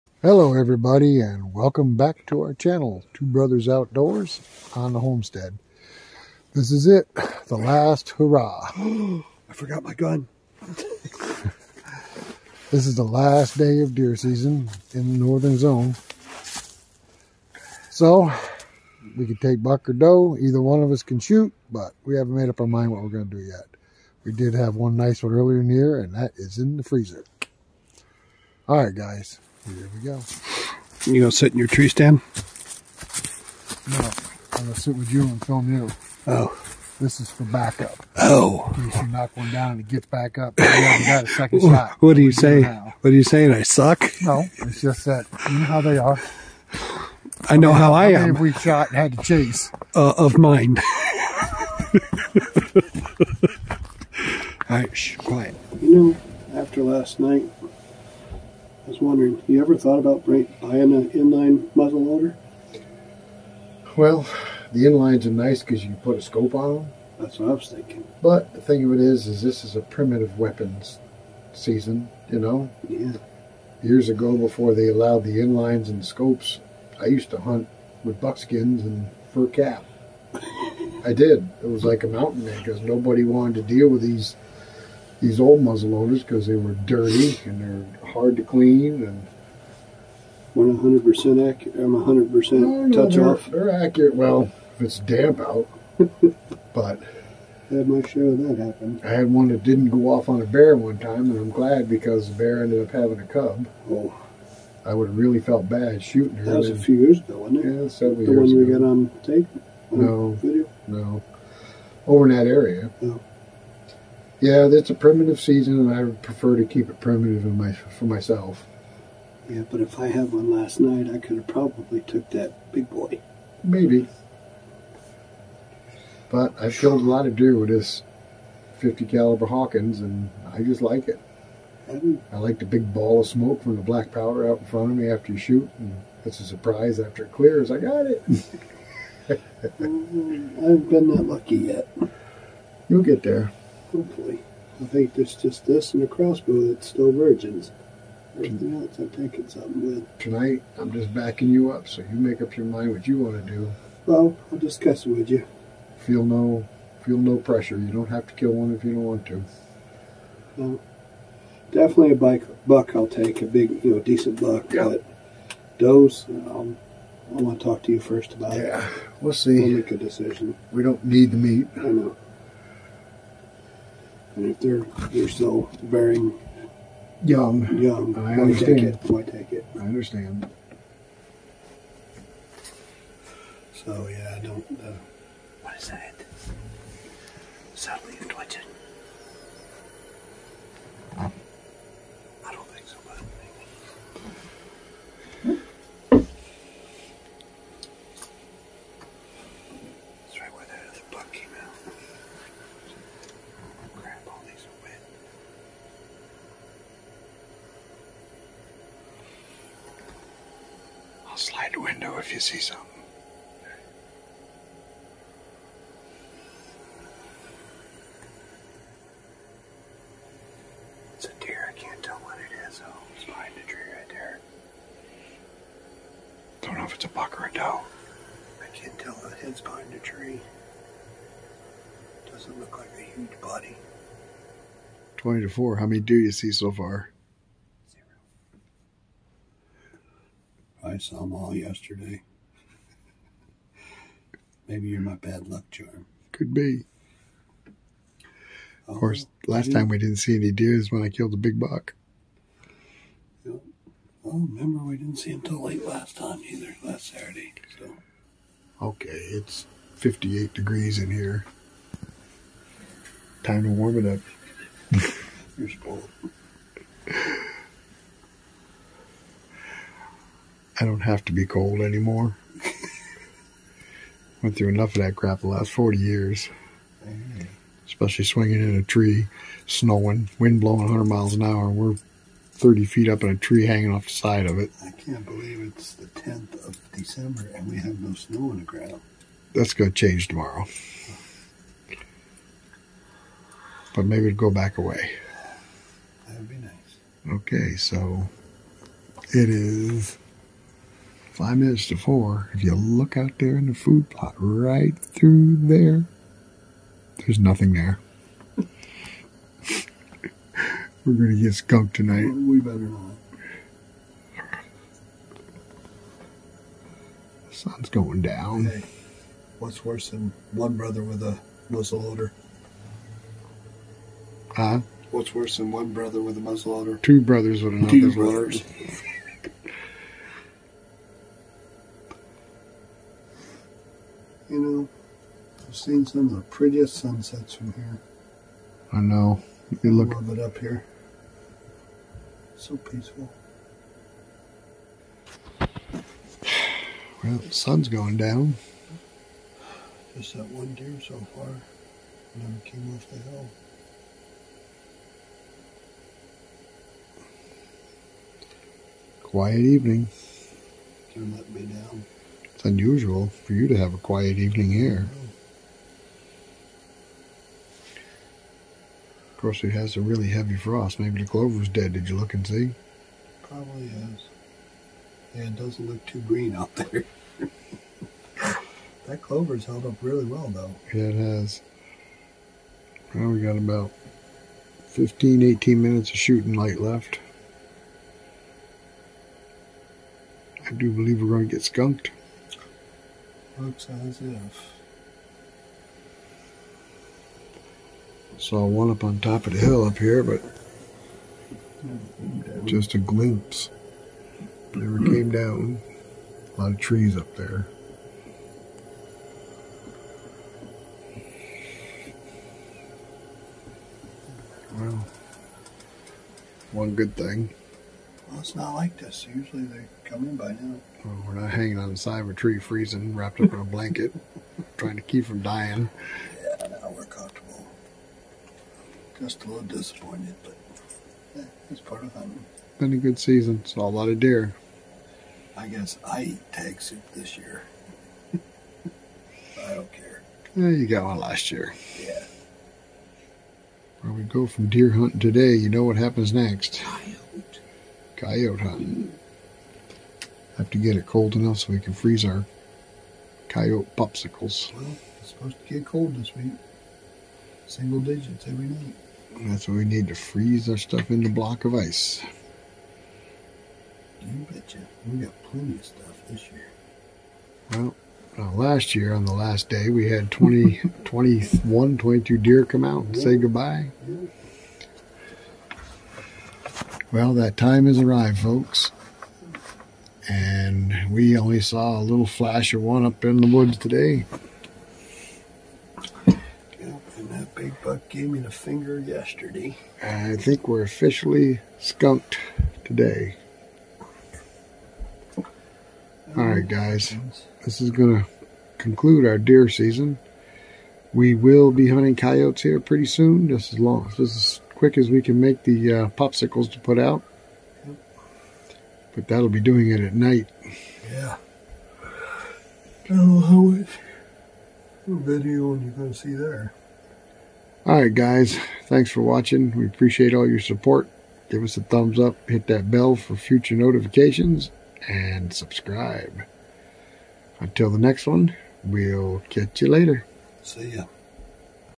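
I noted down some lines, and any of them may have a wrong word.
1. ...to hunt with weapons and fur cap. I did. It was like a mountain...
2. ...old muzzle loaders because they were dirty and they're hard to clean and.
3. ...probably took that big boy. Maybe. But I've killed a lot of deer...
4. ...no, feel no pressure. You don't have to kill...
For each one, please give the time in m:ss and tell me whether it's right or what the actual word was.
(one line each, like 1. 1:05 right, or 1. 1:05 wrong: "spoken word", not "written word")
1. 1:17 wrong: "buckskins", not "weapons"
2. 1:25 right
3. 2:01 right
4. 2:36 right.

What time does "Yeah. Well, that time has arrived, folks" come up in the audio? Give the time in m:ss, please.
7:54.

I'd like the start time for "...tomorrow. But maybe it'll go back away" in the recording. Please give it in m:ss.
4:50.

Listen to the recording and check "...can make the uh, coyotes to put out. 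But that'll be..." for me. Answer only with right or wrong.
wrong.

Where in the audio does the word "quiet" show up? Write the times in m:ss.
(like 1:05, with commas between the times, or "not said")
0:55, 5:59, 6:03.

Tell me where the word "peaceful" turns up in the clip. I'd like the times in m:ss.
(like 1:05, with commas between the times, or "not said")
5:42.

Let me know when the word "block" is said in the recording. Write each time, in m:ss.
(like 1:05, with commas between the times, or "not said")
7:41.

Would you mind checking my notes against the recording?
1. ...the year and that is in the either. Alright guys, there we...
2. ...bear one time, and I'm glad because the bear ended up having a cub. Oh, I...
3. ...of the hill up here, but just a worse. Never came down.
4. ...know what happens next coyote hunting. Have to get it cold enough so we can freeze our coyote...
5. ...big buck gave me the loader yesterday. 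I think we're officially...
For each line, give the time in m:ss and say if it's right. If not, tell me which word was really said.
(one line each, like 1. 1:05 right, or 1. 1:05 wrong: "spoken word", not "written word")
1. 0:25 wrong: "freezer", not "either"
2. 1:40 right
3. 6:39 wrong: "glimpse", not "worse"
4. 7:25 right
5. 8:07 wrong: "finger", not "loader".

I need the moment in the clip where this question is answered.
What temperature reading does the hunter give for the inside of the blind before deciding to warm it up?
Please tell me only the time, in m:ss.
4:19.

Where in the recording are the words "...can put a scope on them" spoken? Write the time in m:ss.
1:05.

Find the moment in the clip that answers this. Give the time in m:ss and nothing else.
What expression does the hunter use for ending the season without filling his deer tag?
7:16.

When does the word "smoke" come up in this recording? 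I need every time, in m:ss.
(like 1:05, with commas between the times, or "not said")
2:13.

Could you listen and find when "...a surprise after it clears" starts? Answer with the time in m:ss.
2:16.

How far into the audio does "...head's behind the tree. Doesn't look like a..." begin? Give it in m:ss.
3:49.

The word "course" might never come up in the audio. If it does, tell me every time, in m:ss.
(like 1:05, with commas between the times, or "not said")
4:08, 6:09.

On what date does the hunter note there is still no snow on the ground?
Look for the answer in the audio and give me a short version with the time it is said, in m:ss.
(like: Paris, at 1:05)
10th of December, at 4:46.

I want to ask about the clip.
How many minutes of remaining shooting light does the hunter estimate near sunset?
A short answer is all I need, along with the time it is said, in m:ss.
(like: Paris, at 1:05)
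15 to 18 minutes, at 6:24.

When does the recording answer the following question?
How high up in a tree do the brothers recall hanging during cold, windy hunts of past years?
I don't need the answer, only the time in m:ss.
4:42.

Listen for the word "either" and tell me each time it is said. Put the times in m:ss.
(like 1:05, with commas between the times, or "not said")
0:20, 4:16.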